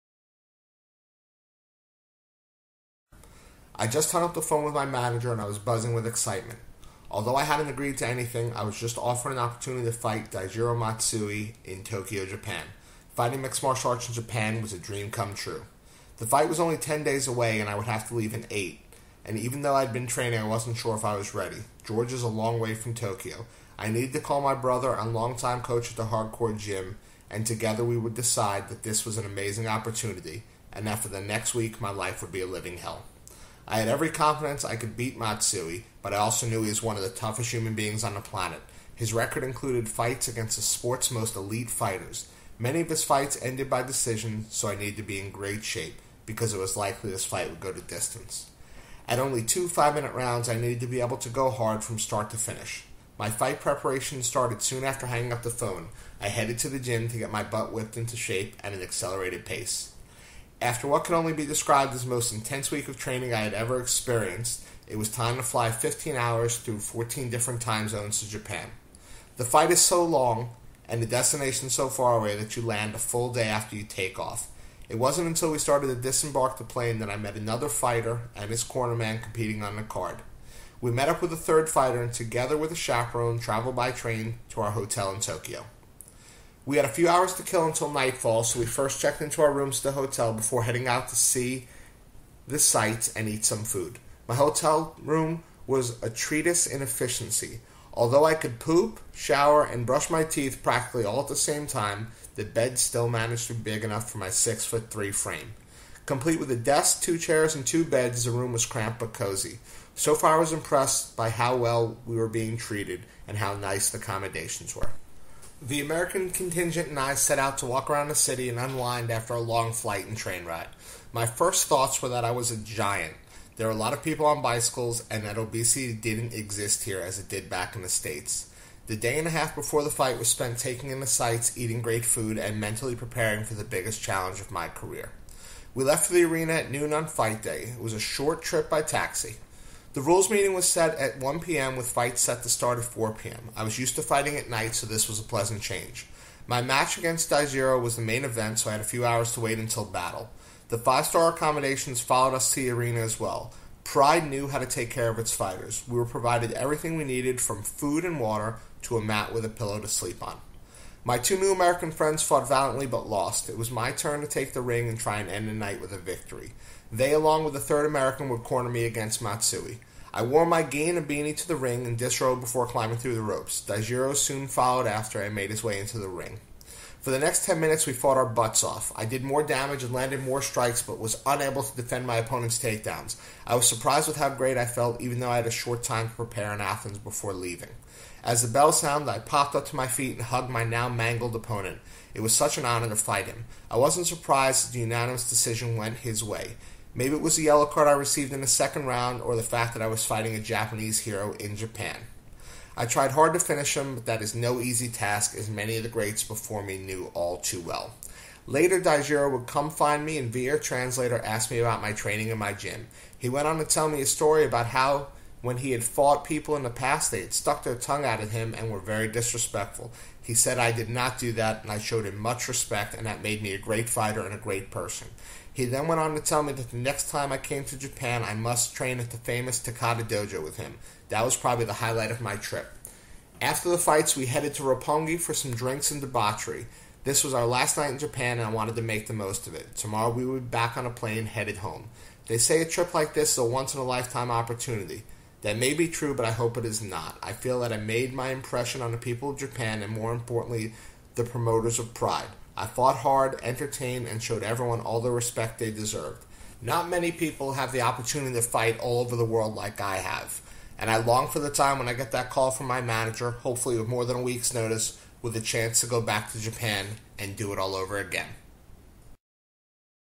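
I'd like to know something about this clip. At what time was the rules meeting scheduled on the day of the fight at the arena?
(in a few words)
1 p.m.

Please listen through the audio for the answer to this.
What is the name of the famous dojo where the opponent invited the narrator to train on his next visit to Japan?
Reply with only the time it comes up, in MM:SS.
03:49.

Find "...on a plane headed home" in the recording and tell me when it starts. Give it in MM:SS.
04:00.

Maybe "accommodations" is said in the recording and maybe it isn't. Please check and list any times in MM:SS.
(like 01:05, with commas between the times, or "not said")
01:53, 02:31.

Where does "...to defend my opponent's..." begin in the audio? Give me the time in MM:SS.
03:01.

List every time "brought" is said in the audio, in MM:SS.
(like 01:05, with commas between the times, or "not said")
not said.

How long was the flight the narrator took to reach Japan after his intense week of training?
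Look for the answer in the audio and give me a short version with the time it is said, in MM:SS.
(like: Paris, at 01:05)
15 hours, at 01:05.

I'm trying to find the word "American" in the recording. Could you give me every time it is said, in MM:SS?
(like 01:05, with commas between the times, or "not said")
01:55, 02:41, 02:47.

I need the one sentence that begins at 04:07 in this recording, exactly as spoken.
I feel that I made my impression on the people of Japan and, more importantly, the promoters of Pride.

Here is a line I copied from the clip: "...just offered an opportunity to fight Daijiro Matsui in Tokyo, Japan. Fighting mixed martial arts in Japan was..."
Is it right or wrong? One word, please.
right.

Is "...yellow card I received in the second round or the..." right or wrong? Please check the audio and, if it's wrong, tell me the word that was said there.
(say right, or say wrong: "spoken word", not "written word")
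right.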